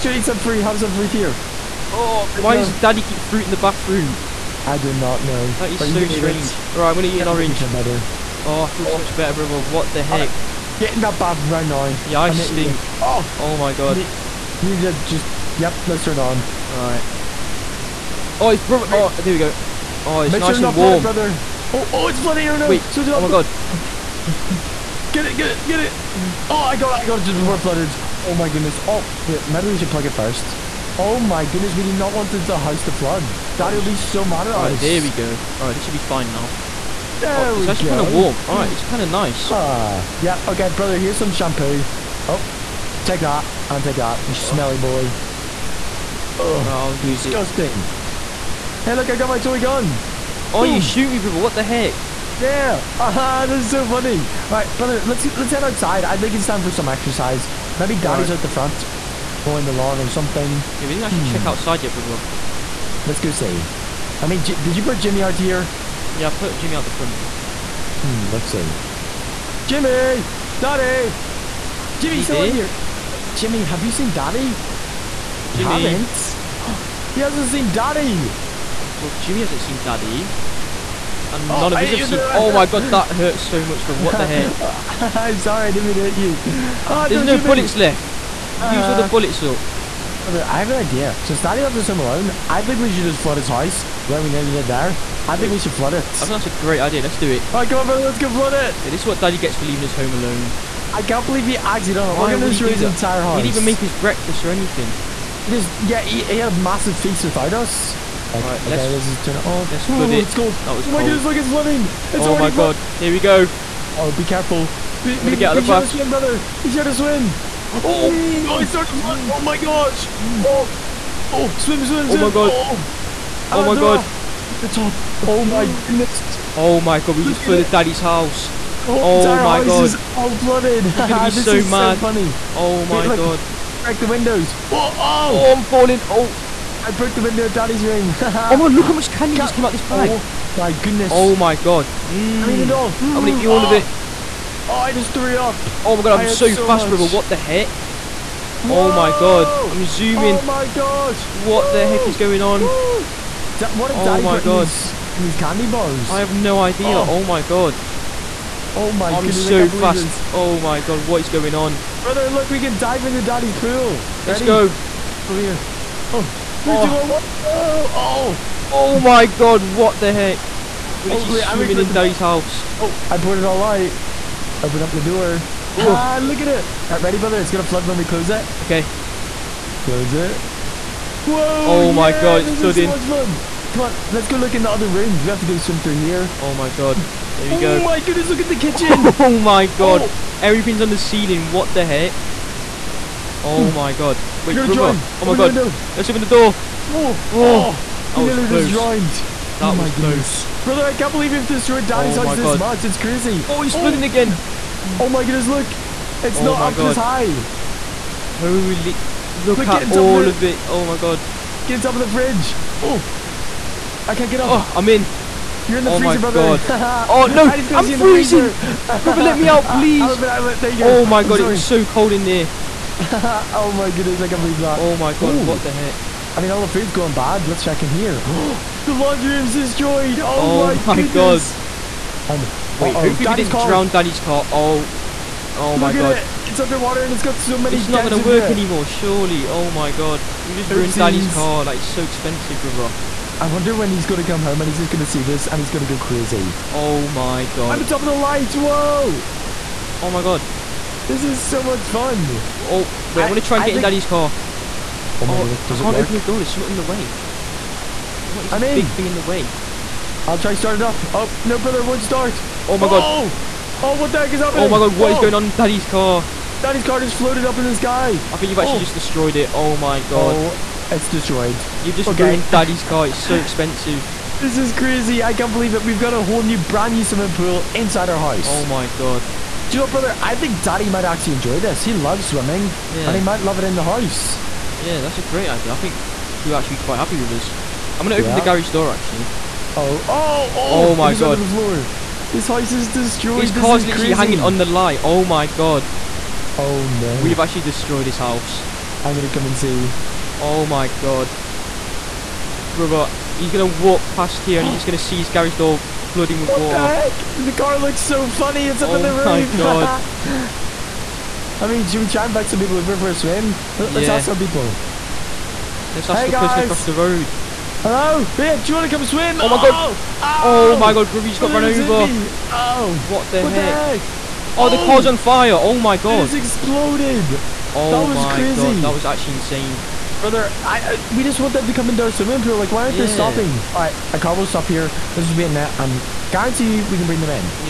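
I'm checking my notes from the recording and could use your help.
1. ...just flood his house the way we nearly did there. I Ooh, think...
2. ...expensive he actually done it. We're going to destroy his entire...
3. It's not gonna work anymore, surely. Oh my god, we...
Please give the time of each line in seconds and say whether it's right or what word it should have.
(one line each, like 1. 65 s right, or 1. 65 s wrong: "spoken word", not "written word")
1. 93 s wrong: "Dude", not "Ooh"
2. 101 s wrong: "believe", not "expensive"
3. 237 s right.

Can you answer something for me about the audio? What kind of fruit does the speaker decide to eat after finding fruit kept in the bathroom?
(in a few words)
Orange.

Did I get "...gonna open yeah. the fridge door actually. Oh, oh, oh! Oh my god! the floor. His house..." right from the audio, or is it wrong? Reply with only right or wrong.
wrong.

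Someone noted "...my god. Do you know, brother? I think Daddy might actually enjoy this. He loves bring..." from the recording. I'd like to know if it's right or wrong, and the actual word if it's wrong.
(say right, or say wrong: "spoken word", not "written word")
wrong: "swimming", not "bring".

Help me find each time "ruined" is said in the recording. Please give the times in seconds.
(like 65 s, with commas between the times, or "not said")
240 s, 272 s.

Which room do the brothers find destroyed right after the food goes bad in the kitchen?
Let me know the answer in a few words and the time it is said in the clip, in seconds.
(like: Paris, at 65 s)
Laundry room, at 228 s.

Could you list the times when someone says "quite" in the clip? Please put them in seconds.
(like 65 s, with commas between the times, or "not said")
286 s.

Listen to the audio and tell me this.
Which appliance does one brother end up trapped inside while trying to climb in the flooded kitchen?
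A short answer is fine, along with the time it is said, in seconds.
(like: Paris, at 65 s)
Freezer, at 215 s.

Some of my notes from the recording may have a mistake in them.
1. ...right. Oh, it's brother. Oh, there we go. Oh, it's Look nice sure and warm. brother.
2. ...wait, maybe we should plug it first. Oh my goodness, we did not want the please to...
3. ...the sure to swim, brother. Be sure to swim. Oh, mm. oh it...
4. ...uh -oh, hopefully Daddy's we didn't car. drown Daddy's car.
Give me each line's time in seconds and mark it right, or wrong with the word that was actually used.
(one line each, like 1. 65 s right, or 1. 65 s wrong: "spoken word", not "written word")
1. 16 s wrong: "Make", not "Look"
2. 29 s wrong: "house", not "please"
3. 115 s right
4. 232 s right.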